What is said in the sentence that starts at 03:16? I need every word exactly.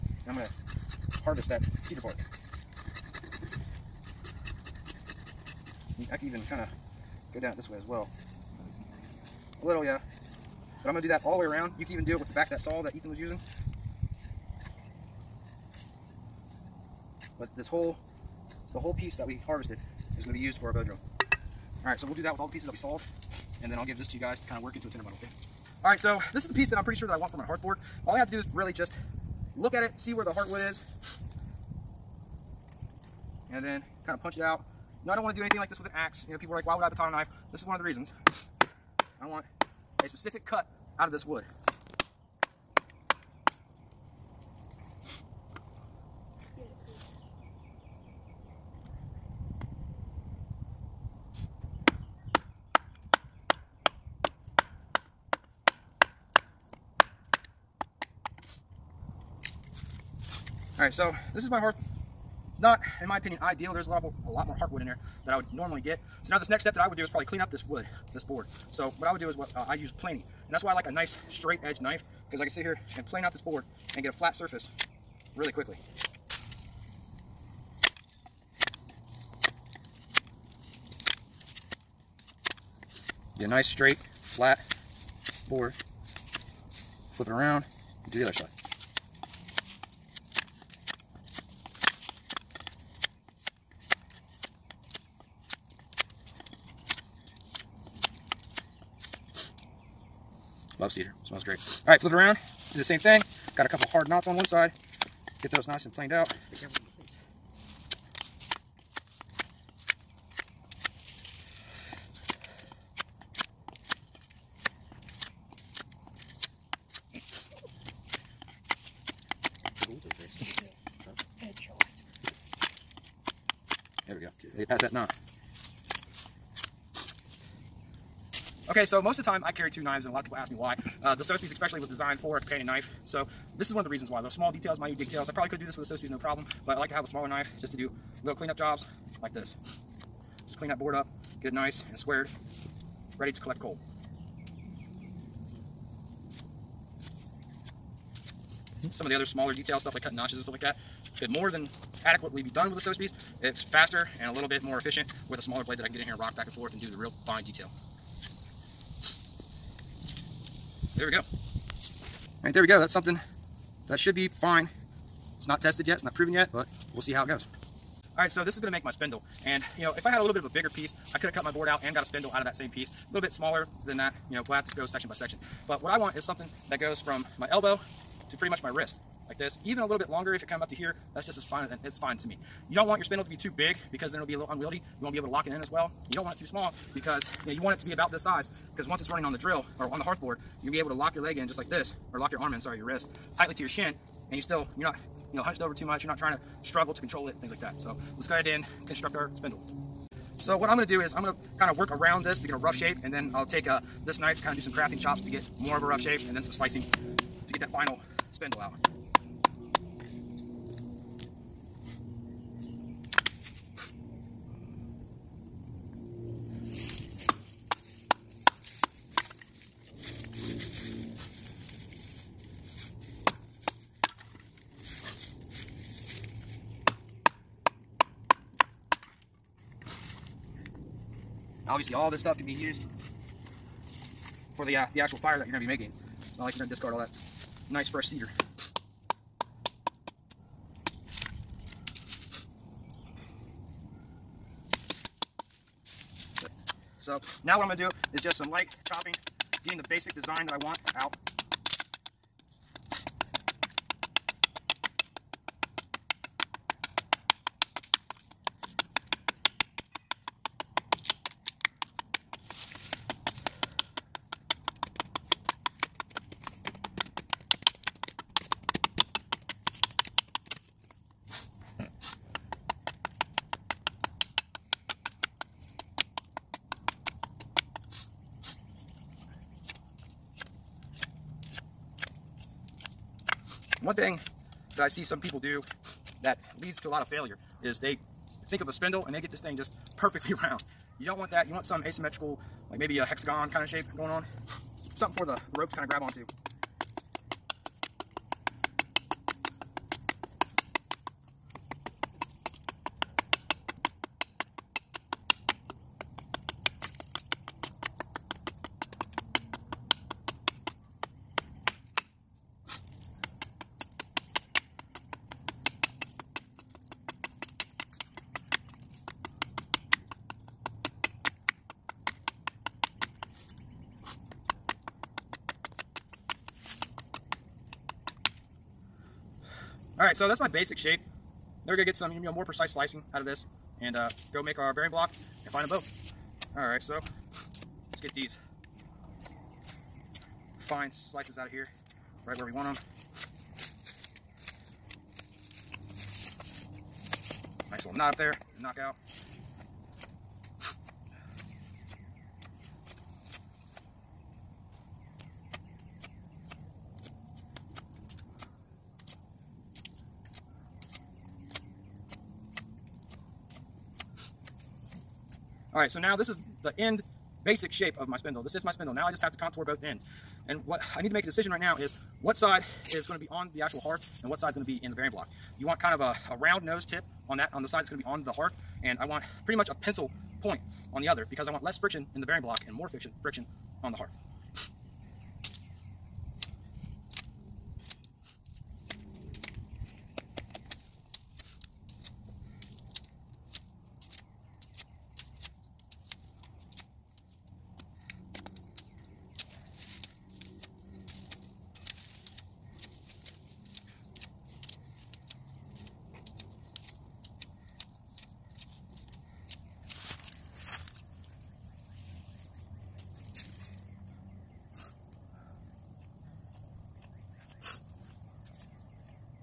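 You're not trying to struggle to control it, things like that.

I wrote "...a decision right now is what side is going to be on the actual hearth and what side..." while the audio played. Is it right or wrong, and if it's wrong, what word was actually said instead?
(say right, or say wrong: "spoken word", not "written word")
right.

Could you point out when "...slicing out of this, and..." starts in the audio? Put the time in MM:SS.
05:32.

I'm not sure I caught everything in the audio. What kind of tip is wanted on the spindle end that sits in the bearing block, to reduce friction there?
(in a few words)
Pencil point.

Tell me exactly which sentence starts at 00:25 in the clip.
Alright, so this is the piece that I'm pretty sure that I want for my hearthboard.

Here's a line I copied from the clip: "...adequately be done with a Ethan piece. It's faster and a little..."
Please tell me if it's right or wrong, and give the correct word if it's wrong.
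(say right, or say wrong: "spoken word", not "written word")
wrong: "SOS", not "Ethan".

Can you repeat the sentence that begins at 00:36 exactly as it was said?
You know, people are like, why would I baton a knife?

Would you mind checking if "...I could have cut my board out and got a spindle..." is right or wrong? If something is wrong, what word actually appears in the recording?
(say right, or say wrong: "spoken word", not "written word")
right.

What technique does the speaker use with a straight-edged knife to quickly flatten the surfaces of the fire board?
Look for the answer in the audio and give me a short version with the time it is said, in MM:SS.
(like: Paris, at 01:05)
Planing, at 01:09.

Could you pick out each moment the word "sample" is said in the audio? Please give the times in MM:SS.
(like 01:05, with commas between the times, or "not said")
not said.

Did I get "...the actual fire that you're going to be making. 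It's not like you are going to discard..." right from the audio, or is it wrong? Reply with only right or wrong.
right.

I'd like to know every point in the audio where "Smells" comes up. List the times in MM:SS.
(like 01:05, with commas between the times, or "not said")
01:41.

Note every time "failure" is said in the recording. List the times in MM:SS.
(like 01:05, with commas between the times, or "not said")
04:47.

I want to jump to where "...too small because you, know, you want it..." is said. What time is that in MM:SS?
03:06.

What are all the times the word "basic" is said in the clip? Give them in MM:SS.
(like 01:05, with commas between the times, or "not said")
04:09, 05:30, 06:07.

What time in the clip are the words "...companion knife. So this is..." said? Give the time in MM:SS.
02:12.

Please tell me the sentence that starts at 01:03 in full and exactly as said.
There's a lot more, a lot more heartwood in there that I would normally get.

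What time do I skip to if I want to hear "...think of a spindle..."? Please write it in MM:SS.
04:48.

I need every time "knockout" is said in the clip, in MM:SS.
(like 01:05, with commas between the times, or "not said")
05:48.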